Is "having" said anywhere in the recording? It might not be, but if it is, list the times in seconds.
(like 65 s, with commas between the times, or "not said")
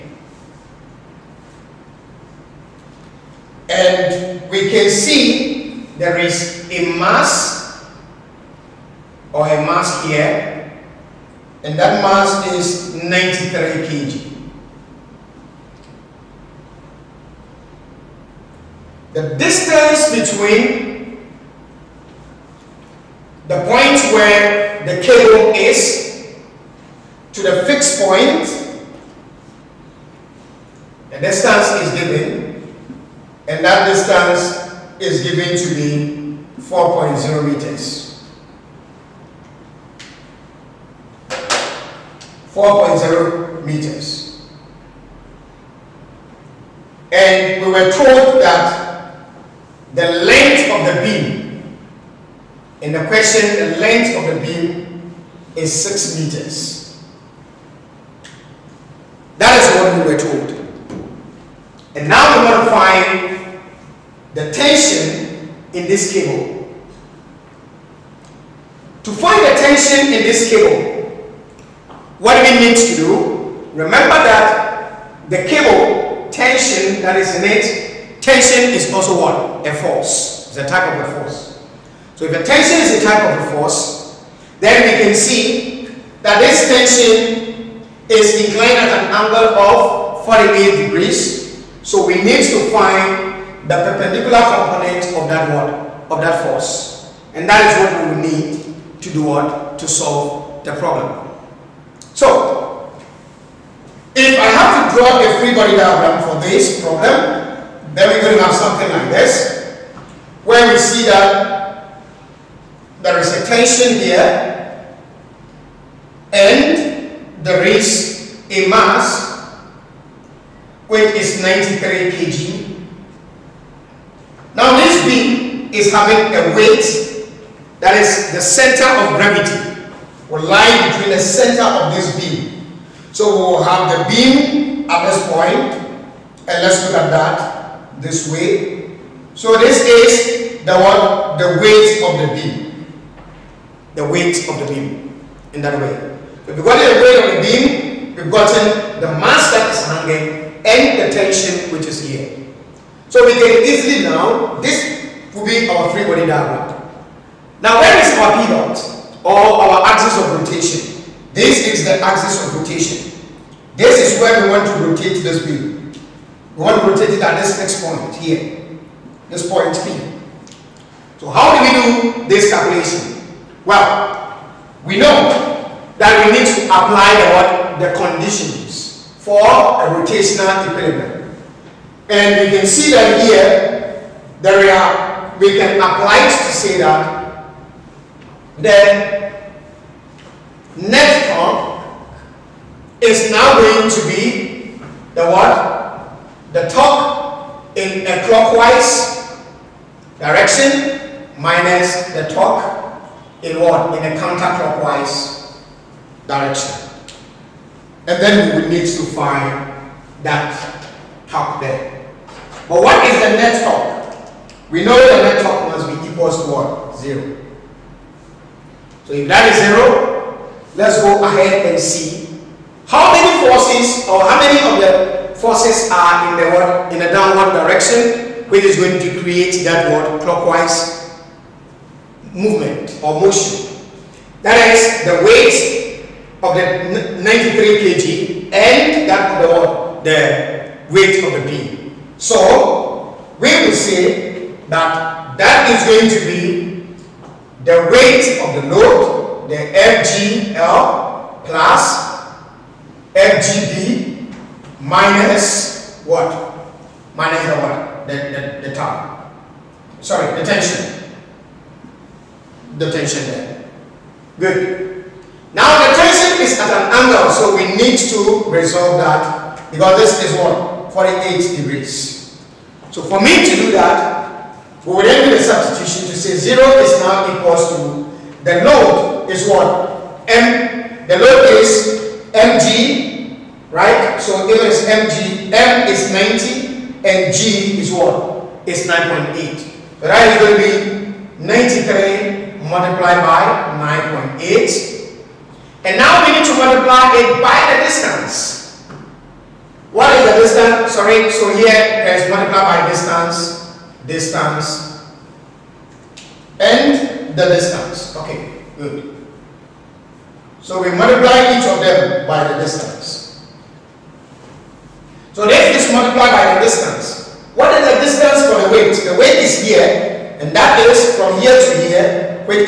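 125 s.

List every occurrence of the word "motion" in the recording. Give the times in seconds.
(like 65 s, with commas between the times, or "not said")
233 s.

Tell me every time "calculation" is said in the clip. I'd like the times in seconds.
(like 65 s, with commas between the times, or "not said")
172 s.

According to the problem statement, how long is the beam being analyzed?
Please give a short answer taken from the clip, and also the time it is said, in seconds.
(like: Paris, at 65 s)
6 meters, at 55 s.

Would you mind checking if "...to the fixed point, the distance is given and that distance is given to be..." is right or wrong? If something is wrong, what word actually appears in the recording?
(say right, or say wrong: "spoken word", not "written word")
right.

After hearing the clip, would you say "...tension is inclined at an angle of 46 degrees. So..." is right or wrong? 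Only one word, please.
wrong.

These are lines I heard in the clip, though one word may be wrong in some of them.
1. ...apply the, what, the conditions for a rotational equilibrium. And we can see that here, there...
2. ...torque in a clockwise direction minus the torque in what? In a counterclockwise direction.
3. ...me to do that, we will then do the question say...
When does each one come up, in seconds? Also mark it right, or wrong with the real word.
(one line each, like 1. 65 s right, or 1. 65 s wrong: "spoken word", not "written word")
1. 176 s right
2. 196 s right
3. 273 s wrong: "substitution", not "question".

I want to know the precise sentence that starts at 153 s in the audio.
So we can easily now, this will be our free body diagram.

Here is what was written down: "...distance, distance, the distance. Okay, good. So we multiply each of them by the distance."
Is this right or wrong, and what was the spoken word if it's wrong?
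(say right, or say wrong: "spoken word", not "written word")
right.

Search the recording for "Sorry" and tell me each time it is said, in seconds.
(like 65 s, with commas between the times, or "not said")
259 s, 300 s.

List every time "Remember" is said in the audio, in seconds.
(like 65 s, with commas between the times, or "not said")
73 s.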